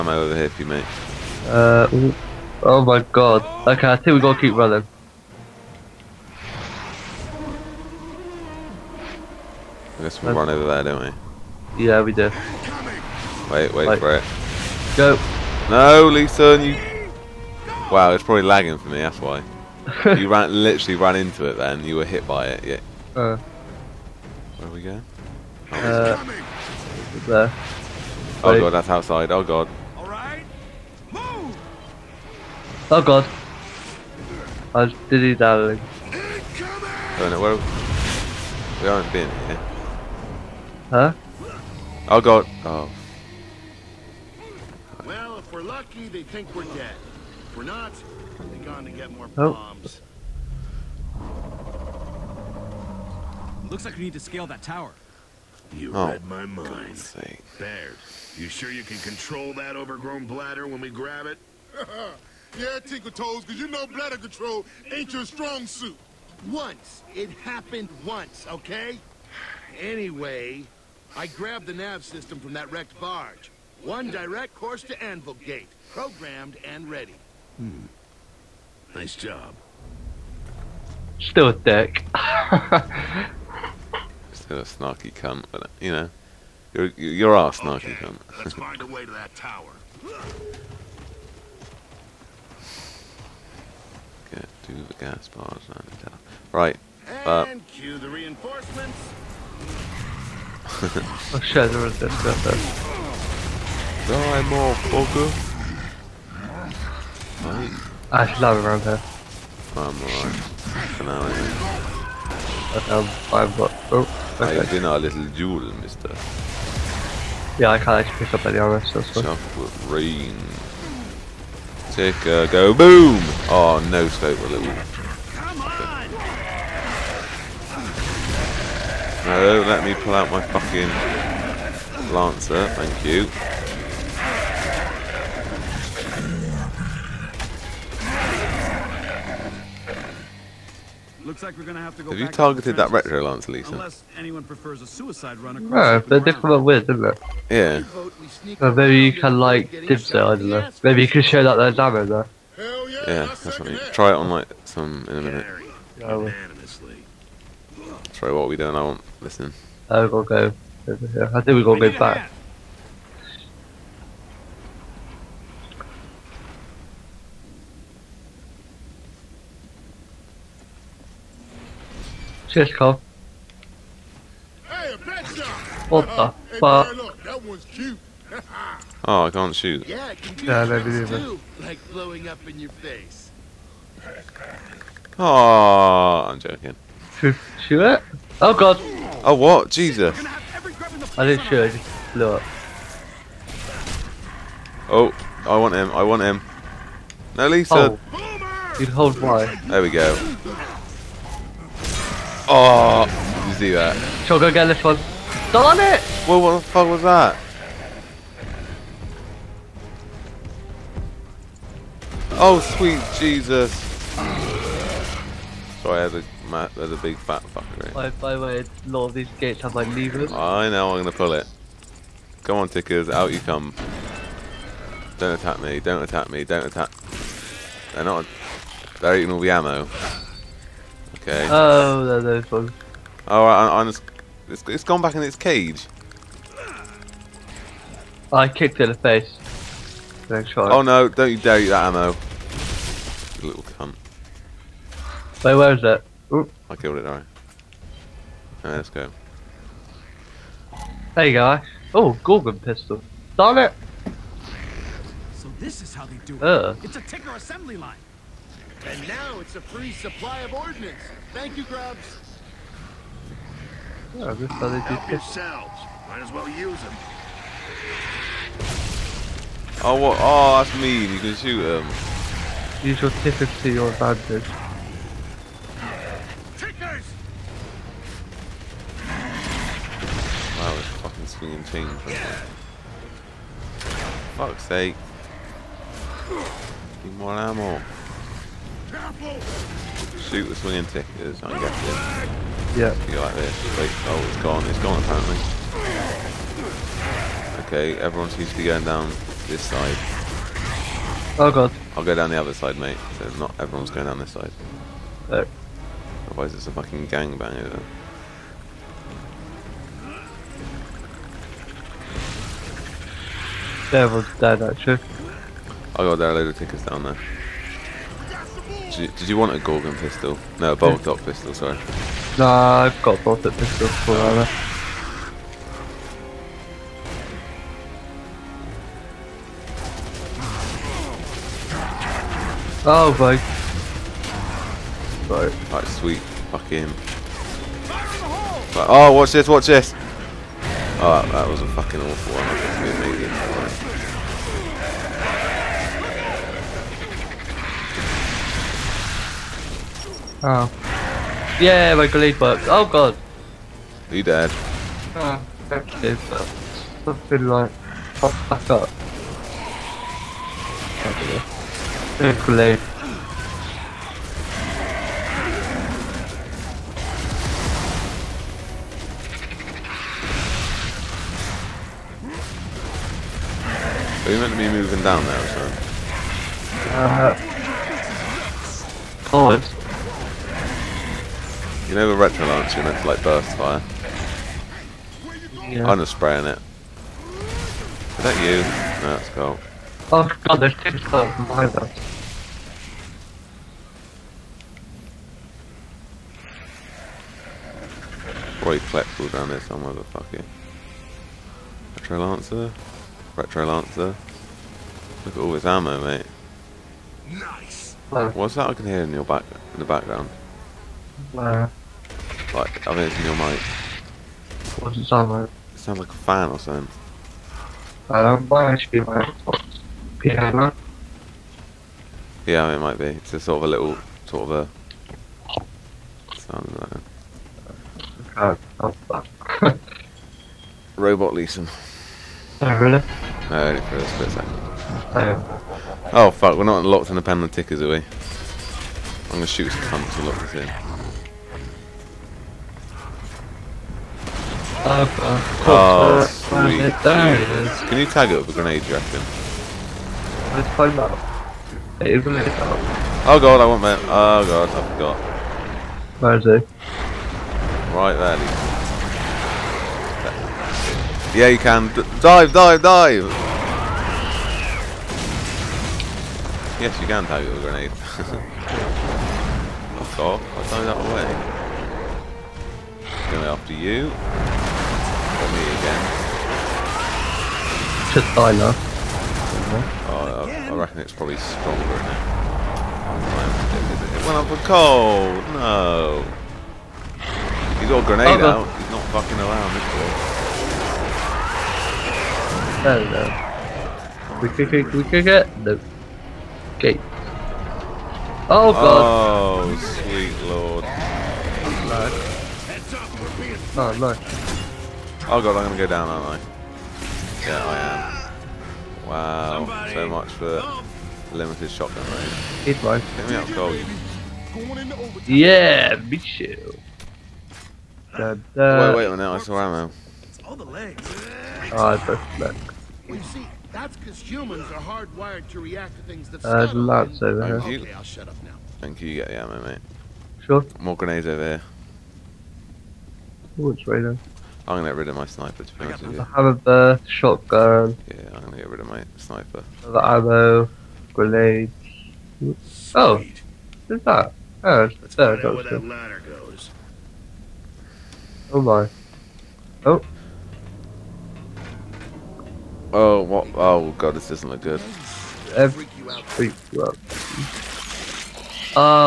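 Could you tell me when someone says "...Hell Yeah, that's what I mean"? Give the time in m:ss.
2:32.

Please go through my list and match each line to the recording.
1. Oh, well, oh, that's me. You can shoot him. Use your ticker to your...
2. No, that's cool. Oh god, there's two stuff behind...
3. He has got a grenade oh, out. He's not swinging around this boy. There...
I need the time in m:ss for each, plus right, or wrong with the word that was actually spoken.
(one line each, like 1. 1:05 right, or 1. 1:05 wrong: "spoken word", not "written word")
1. 4:29 right
2. 6:29 right
3. 8:07 wrong: "fucking", not "swinging".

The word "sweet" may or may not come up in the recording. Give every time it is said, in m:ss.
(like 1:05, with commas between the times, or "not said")
3:32, 5:35, 7:26, 8:20, 9:02.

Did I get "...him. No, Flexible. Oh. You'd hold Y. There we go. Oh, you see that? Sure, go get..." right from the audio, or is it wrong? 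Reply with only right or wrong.
wrong.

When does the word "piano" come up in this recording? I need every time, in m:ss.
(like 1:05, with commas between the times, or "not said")
7:00.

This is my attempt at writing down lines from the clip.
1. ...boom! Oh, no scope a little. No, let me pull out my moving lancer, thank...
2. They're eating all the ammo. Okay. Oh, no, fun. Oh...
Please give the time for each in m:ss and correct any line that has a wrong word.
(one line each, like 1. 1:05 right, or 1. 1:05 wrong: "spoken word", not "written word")
1. 2:02 wrong: "fucking", not "moving"
2. 3:48 right.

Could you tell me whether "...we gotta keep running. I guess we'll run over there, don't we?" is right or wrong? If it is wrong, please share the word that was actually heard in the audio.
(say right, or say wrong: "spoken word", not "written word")
right.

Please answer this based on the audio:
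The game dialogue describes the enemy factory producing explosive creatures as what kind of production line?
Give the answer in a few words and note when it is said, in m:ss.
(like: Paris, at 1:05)
ticker assembly line, at 4:17.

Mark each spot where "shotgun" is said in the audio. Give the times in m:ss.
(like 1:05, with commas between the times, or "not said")
8:31, 8:57.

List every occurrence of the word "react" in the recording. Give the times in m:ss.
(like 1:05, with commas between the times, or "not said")
8:45.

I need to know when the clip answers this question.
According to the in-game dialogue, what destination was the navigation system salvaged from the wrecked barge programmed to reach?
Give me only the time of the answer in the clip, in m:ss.
1:15.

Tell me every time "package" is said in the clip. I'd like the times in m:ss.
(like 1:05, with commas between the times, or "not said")
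not said.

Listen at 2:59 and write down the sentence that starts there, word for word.
Yeah, can do yeah, that video, too, like blowing up in your face.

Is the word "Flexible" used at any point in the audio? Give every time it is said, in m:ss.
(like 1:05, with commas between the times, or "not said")
6:38.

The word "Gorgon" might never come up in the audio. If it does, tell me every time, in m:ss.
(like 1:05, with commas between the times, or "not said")
4:12, 5:19.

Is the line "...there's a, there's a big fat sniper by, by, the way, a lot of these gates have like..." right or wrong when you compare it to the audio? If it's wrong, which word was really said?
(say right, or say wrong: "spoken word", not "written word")
wrong: "fucker", not "sniper".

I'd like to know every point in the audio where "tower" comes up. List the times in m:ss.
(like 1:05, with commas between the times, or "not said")
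0:54, 1:29, 1:36.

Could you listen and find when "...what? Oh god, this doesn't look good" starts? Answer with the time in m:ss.
9:13.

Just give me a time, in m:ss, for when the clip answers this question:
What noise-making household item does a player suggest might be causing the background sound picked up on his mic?
6:56.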